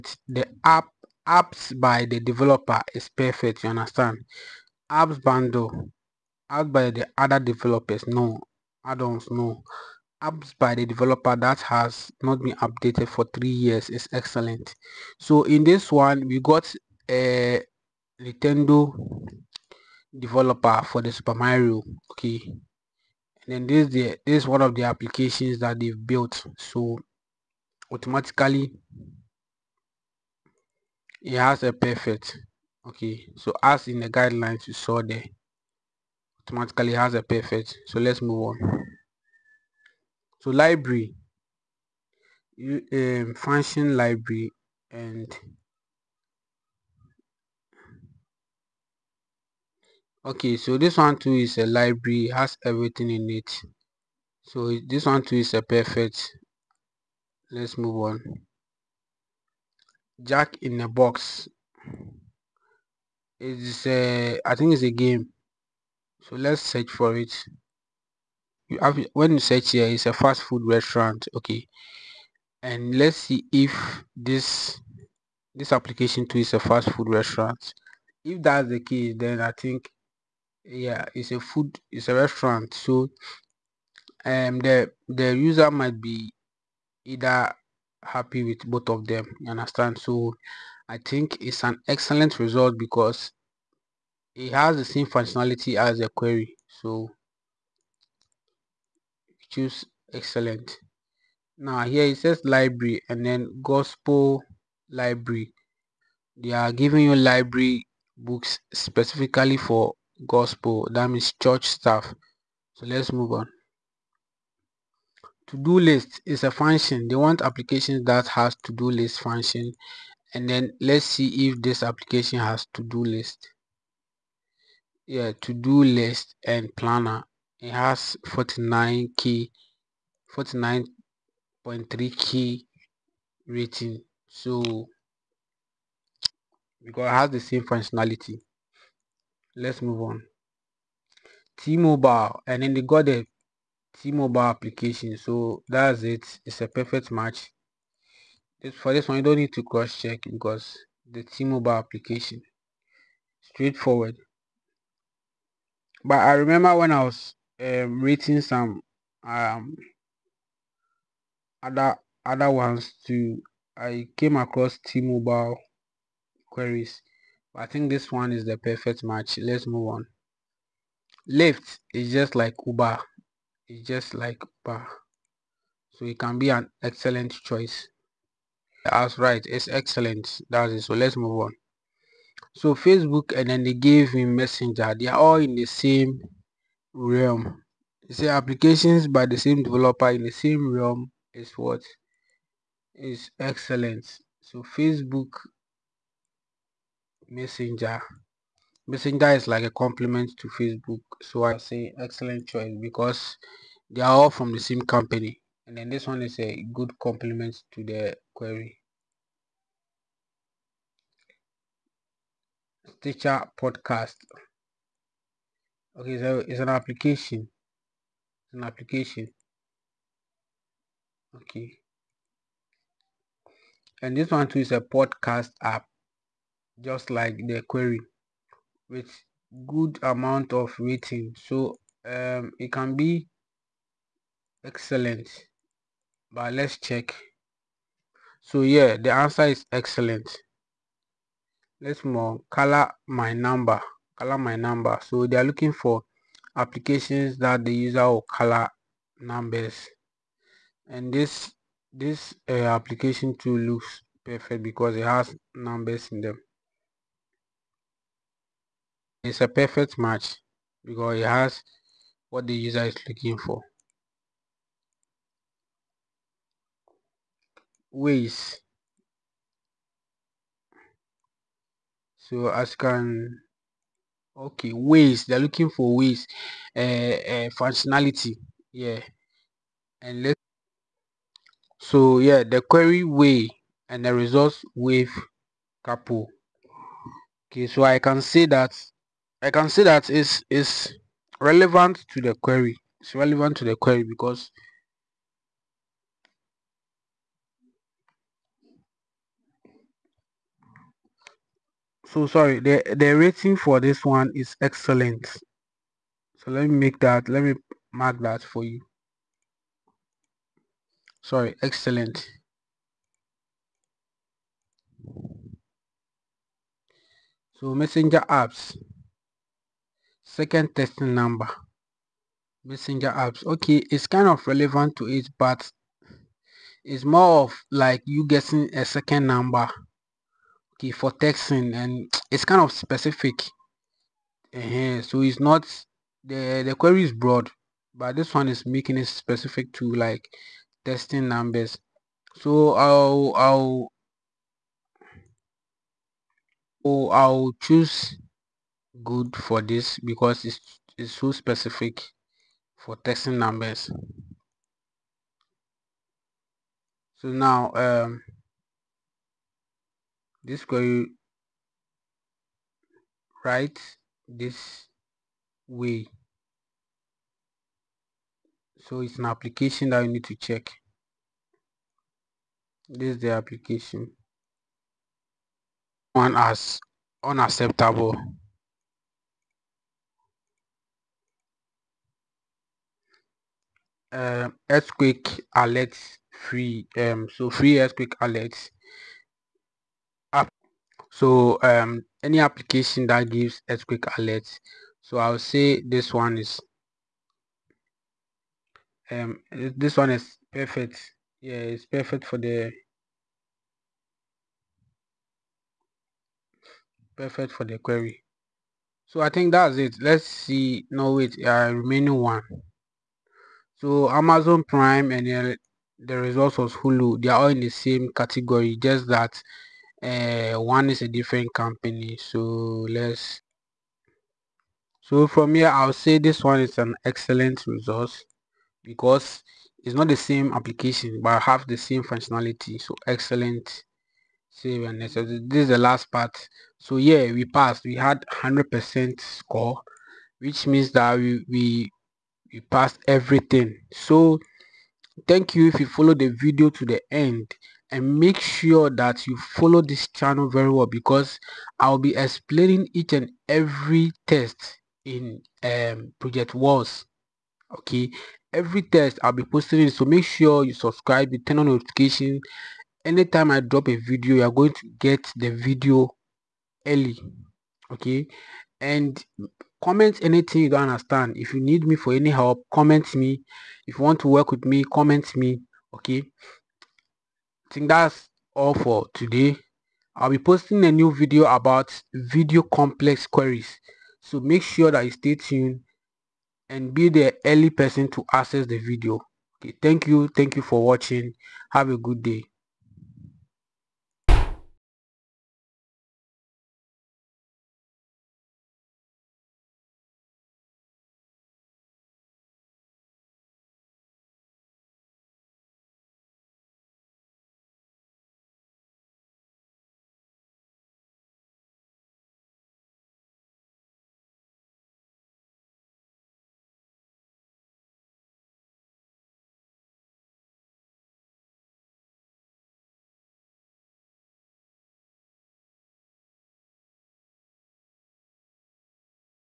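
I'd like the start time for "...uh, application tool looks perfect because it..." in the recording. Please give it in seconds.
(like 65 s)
252 s.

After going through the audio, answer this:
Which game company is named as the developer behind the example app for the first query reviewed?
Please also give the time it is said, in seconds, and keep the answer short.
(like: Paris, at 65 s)
Nintendo, at 18 s.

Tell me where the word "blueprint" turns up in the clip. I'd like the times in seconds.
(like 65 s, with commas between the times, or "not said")
not said.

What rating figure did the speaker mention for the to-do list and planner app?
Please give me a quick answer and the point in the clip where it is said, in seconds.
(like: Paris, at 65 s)
49.3 key, at 130 s.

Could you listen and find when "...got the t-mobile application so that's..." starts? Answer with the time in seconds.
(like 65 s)
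142 s.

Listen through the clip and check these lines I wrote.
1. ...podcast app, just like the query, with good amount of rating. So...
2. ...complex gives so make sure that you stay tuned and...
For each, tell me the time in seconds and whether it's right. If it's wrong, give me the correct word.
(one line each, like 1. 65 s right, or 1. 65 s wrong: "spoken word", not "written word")
1. 224 s right
2. 482 s wrong: "queries", not "gives".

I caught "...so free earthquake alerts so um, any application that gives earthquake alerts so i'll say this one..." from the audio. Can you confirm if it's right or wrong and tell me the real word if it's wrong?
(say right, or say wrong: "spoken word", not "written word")
right.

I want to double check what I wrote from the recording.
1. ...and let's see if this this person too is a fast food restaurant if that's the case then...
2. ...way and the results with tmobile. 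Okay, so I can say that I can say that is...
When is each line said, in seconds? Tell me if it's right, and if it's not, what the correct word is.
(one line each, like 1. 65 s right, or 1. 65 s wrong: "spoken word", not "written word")
1. 72 s wrong: "application", not "person"
2. 283 s wrong: "couple", not "tmobile".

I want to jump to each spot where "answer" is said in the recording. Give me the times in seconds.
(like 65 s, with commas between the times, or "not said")
239 s.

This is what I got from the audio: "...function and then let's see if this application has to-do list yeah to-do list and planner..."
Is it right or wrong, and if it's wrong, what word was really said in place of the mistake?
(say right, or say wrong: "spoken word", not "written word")
right.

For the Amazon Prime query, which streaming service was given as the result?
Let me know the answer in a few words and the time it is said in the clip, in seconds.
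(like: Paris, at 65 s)
Hulu, at 416 s.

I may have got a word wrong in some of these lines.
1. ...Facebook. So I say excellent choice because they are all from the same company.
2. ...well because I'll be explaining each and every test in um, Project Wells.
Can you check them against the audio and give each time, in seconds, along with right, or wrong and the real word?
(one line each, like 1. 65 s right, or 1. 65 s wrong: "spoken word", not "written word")
1. 200 s right
2. 450 s right.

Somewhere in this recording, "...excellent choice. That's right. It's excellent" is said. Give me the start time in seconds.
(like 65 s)
176 s.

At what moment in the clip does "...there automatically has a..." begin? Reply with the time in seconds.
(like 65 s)
35 s.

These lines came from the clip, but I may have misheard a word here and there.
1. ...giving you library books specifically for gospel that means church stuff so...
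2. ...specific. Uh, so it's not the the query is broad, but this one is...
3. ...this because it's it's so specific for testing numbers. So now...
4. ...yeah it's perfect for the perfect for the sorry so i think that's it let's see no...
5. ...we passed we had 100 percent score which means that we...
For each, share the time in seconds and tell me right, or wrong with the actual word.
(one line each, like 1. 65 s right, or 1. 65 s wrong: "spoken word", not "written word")
1. 106 s right
2. 332 s right
3. 349 s right
4. 401 s wrong: "query", not "sorry"
5. 437 s right.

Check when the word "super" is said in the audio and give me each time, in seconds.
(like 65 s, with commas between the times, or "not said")
21 s.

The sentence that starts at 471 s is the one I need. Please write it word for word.
If you need me for any help, comment me.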